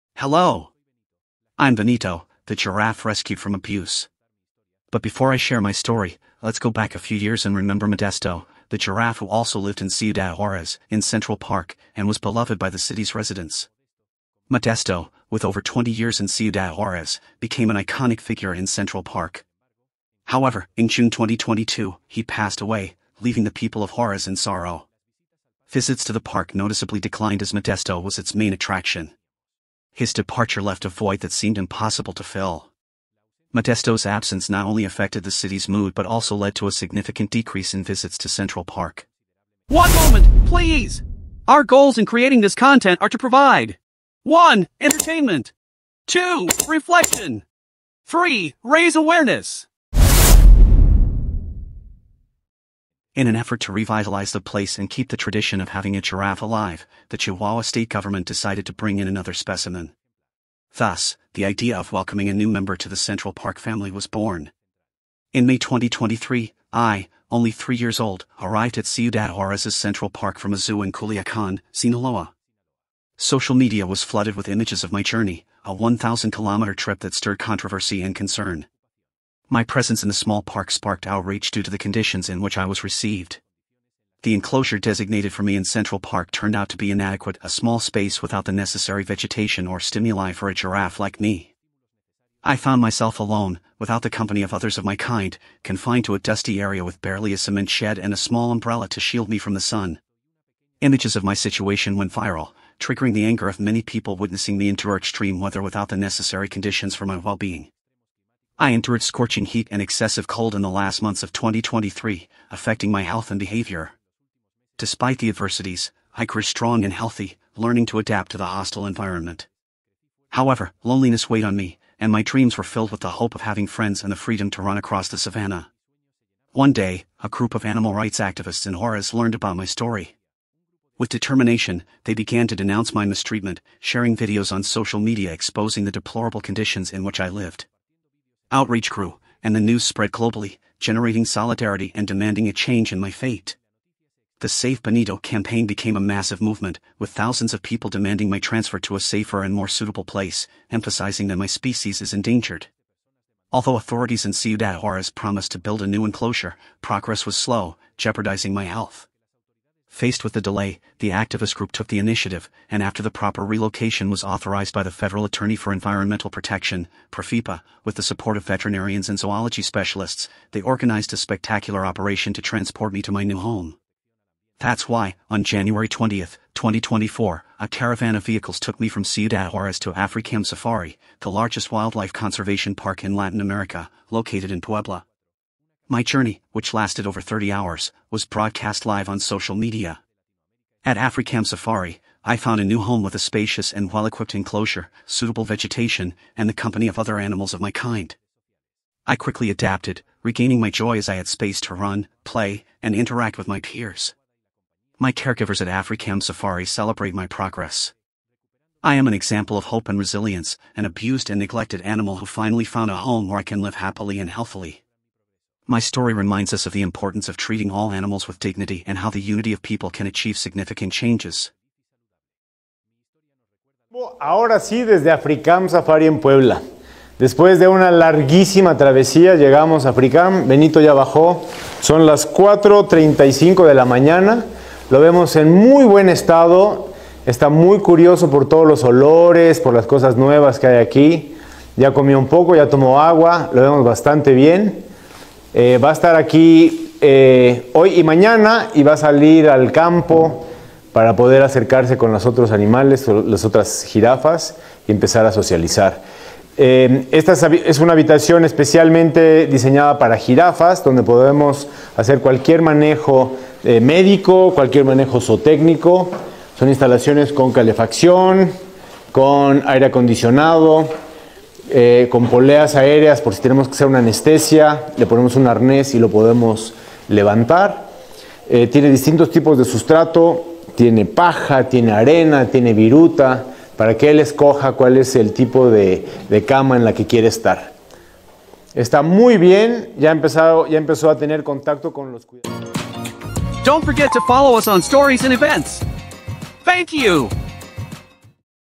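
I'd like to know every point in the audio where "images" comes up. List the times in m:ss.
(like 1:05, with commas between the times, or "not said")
1:14, 1:40.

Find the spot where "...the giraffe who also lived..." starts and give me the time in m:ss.
0:08.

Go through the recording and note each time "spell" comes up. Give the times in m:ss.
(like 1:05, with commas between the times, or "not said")
not said.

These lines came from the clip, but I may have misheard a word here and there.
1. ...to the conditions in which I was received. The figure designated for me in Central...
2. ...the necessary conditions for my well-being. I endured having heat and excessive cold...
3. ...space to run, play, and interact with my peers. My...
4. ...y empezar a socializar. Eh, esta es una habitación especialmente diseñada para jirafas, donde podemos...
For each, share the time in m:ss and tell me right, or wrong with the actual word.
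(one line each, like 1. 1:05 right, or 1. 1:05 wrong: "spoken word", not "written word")
1. 1:21 wrong: "enclosure", not "figure"
2. 1:45 wrong: "scorching", not "having"
3. 3:21 right
4. 4:14 right.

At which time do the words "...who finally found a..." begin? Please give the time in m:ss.
3:32.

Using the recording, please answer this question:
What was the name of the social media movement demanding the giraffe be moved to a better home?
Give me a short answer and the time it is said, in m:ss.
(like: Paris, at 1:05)
Save Benito, at 2:24.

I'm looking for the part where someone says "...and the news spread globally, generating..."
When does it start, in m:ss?
2:19.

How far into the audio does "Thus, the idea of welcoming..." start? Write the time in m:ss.
1:00.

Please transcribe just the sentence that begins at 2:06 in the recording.
One day, a group of animal rights activists in Juarez learned about my story.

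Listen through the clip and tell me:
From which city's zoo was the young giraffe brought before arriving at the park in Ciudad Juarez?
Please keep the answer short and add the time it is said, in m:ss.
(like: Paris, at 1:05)
Culiacan, at 1:10.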